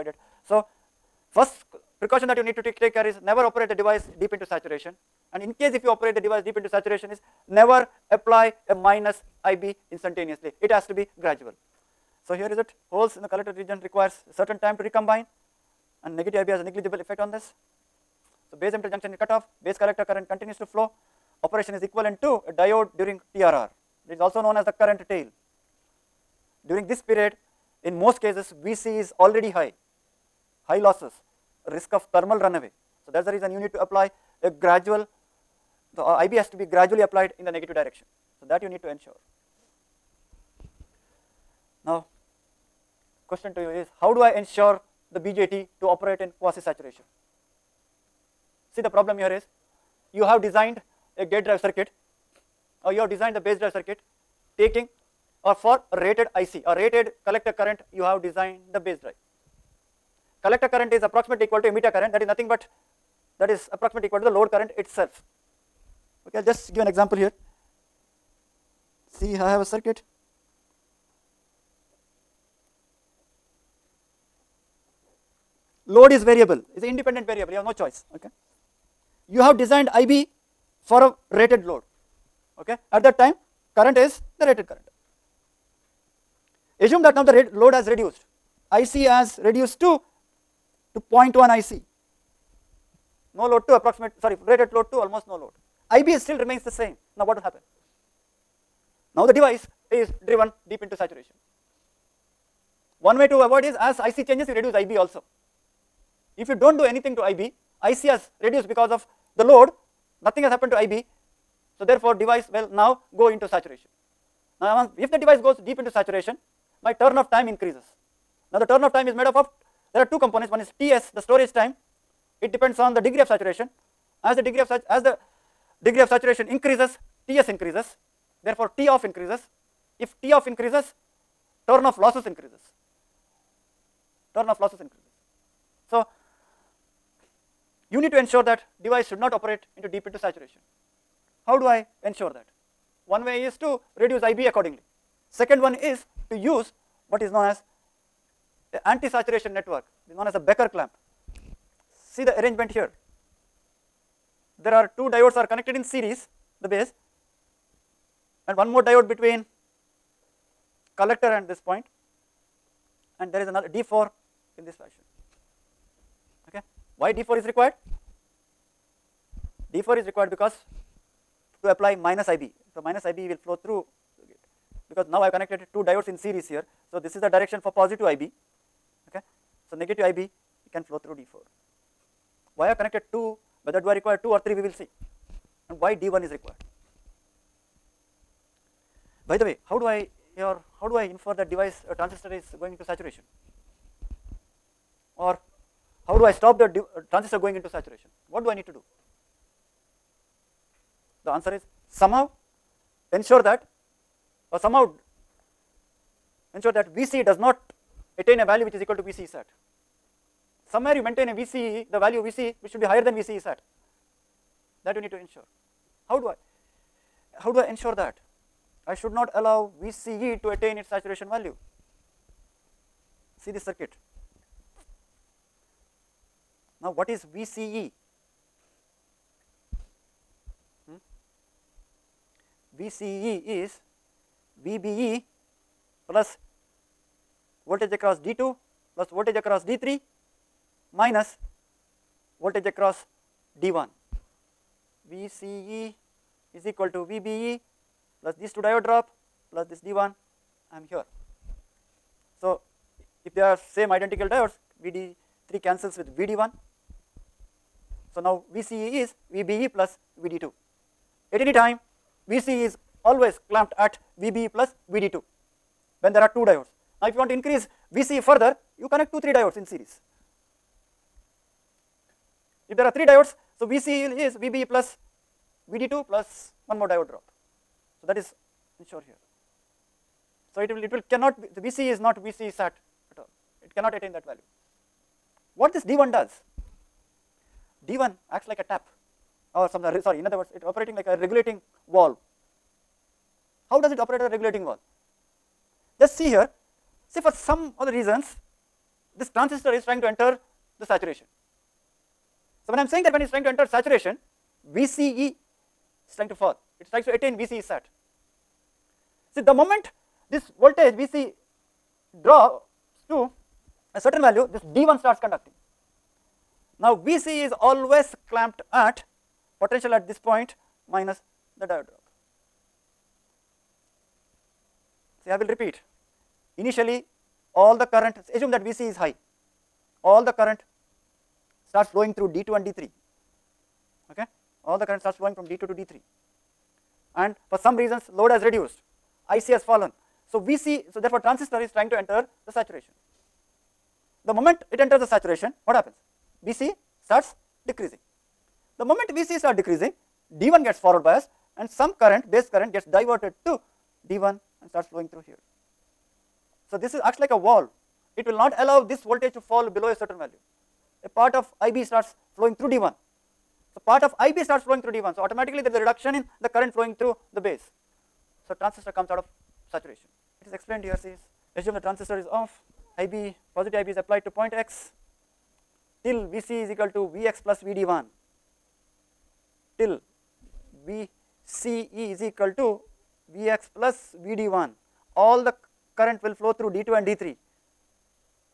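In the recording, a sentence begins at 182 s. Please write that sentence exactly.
Why are connected 2, whether do I require 2 or 3 we will see and why D1 is required.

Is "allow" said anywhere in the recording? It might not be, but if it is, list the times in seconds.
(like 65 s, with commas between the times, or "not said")
219 s, 358 s.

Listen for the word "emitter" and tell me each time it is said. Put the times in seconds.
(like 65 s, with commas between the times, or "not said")
18 s, 61 s.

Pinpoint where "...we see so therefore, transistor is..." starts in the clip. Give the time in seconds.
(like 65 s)
340 s.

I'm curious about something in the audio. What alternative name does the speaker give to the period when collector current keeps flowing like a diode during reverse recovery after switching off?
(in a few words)
current tail.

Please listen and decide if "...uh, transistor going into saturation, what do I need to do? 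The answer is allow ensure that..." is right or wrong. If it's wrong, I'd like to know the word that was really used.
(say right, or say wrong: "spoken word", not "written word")
wrong: "somehow", not "allow".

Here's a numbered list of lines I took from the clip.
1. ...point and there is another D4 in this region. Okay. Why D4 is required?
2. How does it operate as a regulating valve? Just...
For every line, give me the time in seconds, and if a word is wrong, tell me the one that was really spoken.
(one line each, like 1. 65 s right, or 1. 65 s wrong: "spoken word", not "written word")
1. 161 s wrong: "fashion", not "region"
2. 293 s right.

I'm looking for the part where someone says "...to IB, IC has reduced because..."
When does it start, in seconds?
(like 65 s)
107 s.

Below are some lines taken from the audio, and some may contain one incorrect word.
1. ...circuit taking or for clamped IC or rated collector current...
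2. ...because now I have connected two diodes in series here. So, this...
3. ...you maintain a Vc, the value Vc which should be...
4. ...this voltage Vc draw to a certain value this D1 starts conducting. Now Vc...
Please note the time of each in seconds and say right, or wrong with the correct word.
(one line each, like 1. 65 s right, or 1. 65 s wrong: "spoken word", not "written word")
1. 53 s wrong: "rated", not "clamped"
2. 174 s right
3. 210 s right
4. 310 s right.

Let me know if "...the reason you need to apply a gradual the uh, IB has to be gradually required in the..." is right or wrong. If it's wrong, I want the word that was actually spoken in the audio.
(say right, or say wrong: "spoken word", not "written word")
wrong: "applied", not "required".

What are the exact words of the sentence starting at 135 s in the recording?
So, you need to ensure that device should not operate into deep into saturation.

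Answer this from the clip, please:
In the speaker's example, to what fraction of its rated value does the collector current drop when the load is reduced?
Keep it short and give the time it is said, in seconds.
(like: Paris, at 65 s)
0.1, at 91 s.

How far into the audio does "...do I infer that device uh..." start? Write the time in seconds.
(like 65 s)
190 s.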